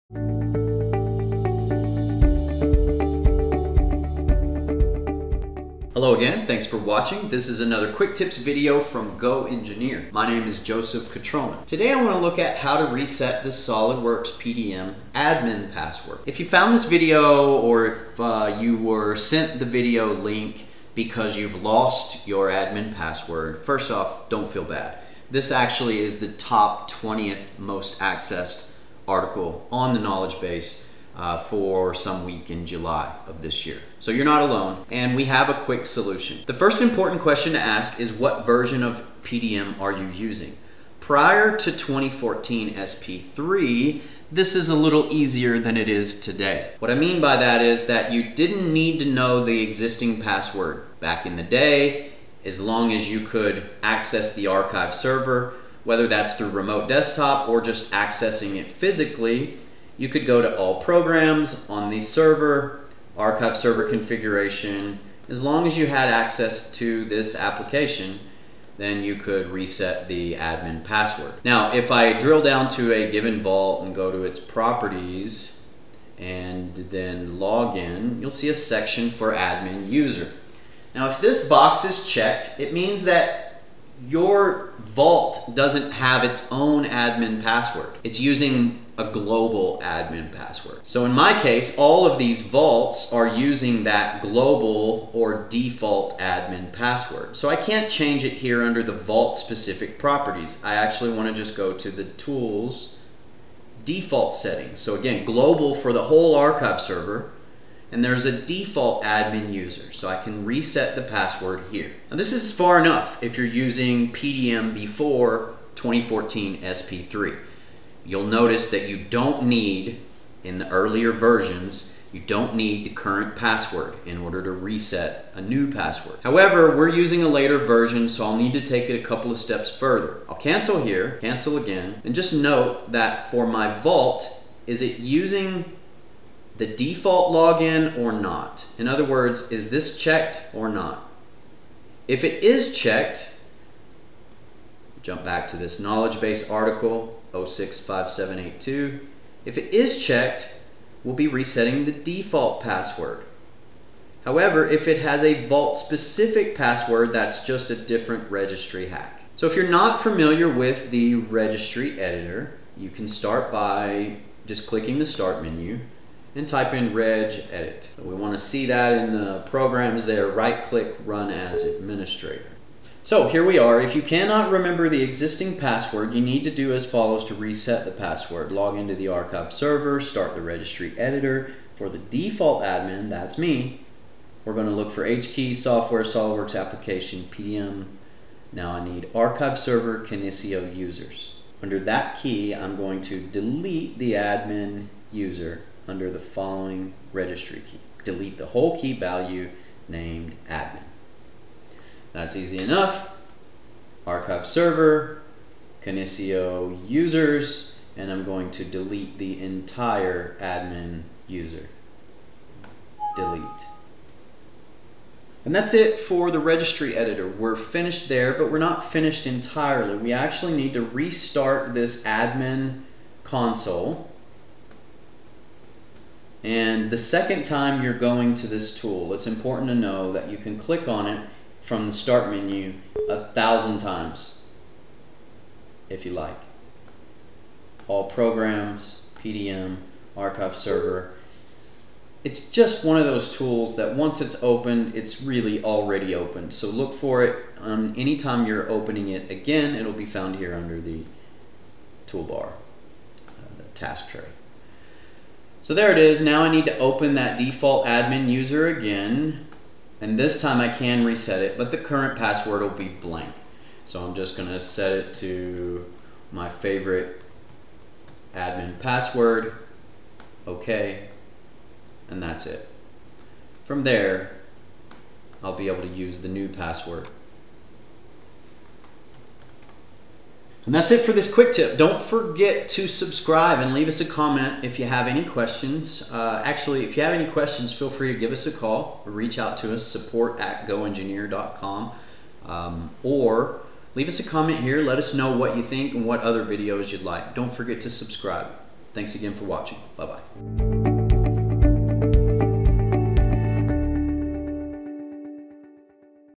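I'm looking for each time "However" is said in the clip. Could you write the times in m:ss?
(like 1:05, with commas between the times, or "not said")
2:06, 2:34.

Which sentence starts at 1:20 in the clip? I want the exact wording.
Now, if this box is checked, it means that your vault doesn't have its own admin password.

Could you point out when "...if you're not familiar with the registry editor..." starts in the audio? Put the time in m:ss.
2:39.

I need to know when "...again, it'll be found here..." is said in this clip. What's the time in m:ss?
4:09.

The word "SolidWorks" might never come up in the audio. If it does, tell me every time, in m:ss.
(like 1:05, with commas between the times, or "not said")
0:13, 3:06.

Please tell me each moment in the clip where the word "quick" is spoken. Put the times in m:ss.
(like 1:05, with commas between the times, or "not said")
0:07, 0:35, 4:41.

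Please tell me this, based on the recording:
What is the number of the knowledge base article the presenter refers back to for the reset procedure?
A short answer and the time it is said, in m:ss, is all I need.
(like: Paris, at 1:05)
065782, at 2:27.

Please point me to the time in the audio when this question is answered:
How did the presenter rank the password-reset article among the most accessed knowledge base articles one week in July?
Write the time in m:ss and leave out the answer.
0:26.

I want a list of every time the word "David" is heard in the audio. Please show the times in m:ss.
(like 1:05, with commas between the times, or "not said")
not said.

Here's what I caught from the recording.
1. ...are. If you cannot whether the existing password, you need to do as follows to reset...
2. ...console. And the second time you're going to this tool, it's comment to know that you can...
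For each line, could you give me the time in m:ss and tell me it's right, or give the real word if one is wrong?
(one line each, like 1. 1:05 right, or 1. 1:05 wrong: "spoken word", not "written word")
1. 2:53 wrong: "remember", not "whether"
2. 3:43 wrong: "important", not "comment".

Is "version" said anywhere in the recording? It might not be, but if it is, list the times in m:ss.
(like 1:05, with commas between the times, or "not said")
0:38, 2:01, 2:07.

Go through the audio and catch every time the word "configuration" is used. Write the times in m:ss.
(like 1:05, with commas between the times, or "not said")
1:03.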